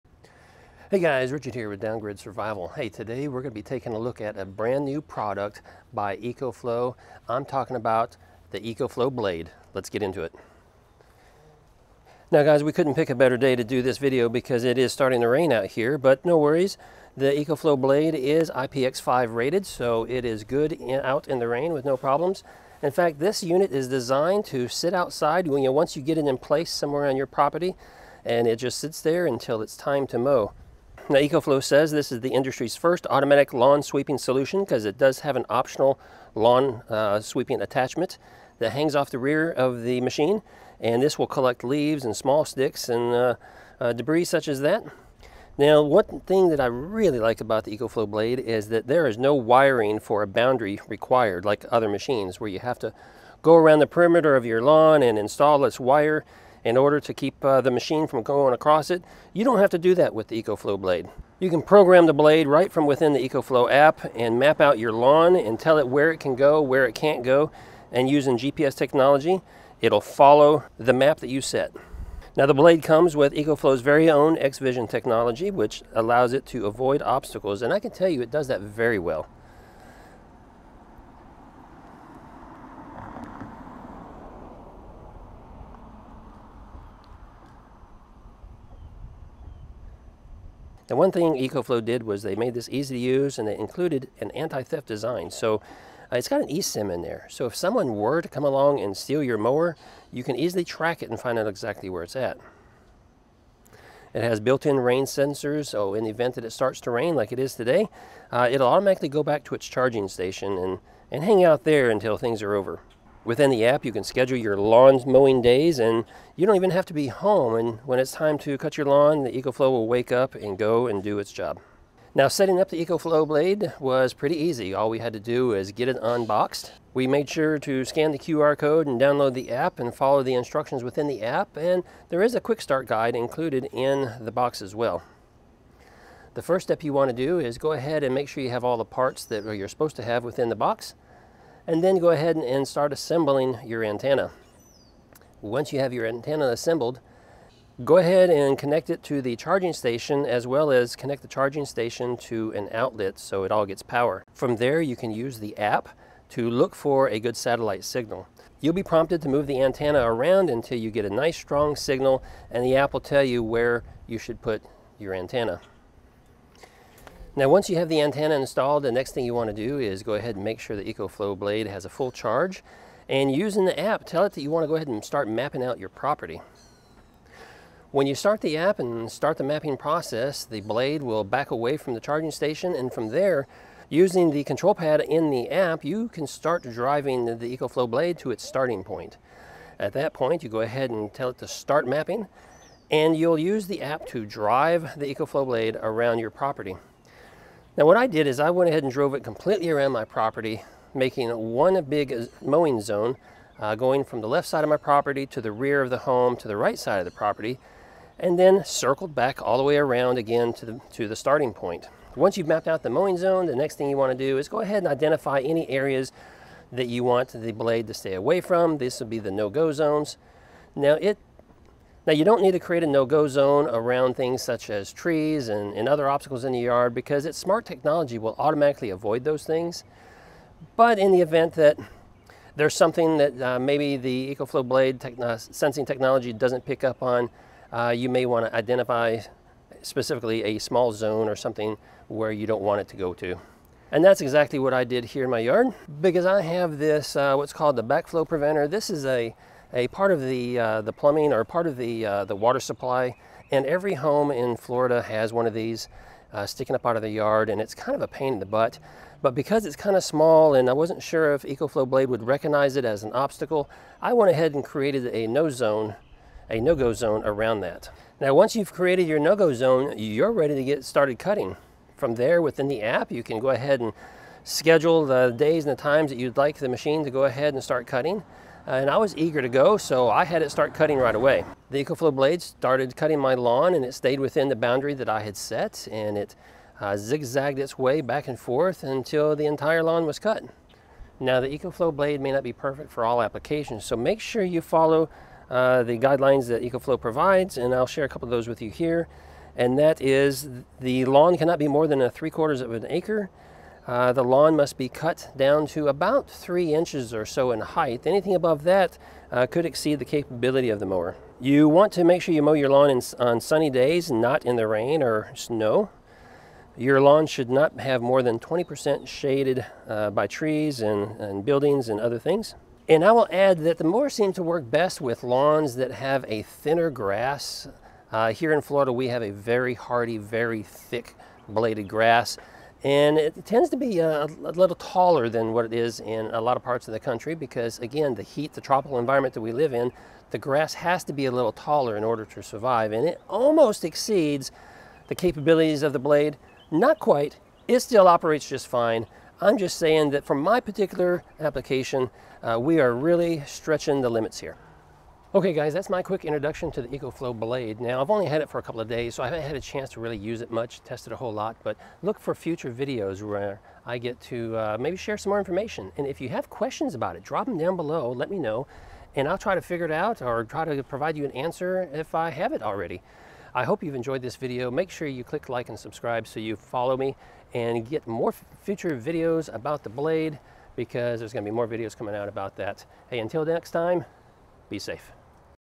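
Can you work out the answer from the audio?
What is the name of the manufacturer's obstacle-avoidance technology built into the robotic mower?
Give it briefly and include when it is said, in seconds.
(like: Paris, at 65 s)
X-Vision, at 74 s.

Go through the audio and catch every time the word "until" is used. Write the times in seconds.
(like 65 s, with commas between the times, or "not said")
29 s, 111 s, 160 s, 288 s, 383 s.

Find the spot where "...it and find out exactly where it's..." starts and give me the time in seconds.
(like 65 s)
101 s.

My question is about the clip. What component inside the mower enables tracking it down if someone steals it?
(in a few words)
eSIM.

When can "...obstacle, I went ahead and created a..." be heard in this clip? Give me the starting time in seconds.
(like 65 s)
263 s.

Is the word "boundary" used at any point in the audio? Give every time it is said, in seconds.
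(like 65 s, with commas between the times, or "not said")
50 s, 284 s.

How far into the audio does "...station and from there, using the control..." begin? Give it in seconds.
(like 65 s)
182 s.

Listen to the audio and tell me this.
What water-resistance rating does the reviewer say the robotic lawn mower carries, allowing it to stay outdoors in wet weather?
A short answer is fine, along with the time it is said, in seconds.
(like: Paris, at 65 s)
IPX5, at 18 s.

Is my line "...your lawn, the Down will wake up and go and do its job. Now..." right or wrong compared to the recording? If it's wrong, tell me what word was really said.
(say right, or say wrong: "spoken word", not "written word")
wrong: "EcoFlow", not "Down".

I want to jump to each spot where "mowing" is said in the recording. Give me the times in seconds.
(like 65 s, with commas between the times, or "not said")
115 s, 202 s, 212 s.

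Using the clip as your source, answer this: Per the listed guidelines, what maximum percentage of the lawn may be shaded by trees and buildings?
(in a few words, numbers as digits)
20%.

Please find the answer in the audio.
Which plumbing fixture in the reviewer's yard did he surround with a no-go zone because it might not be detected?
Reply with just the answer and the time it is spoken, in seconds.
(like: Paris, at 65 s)
backflow preventer, at 247 s.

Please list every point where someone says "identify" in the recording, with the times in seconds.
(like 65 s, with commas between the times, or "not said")
214 s, 238 s.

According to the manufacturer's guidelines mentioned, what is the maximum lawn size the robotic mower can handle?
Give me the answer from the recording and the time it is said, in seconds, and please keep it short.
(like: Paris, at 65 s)
3/4 of an acre, at 302 s.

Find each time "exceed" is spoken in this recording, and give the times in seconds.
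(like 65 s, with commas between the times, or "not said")
309 s, 343 s.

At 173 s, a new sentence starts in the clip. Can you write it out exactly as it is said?
And using the app, tell it that you want to go ahead and start mapping out your property.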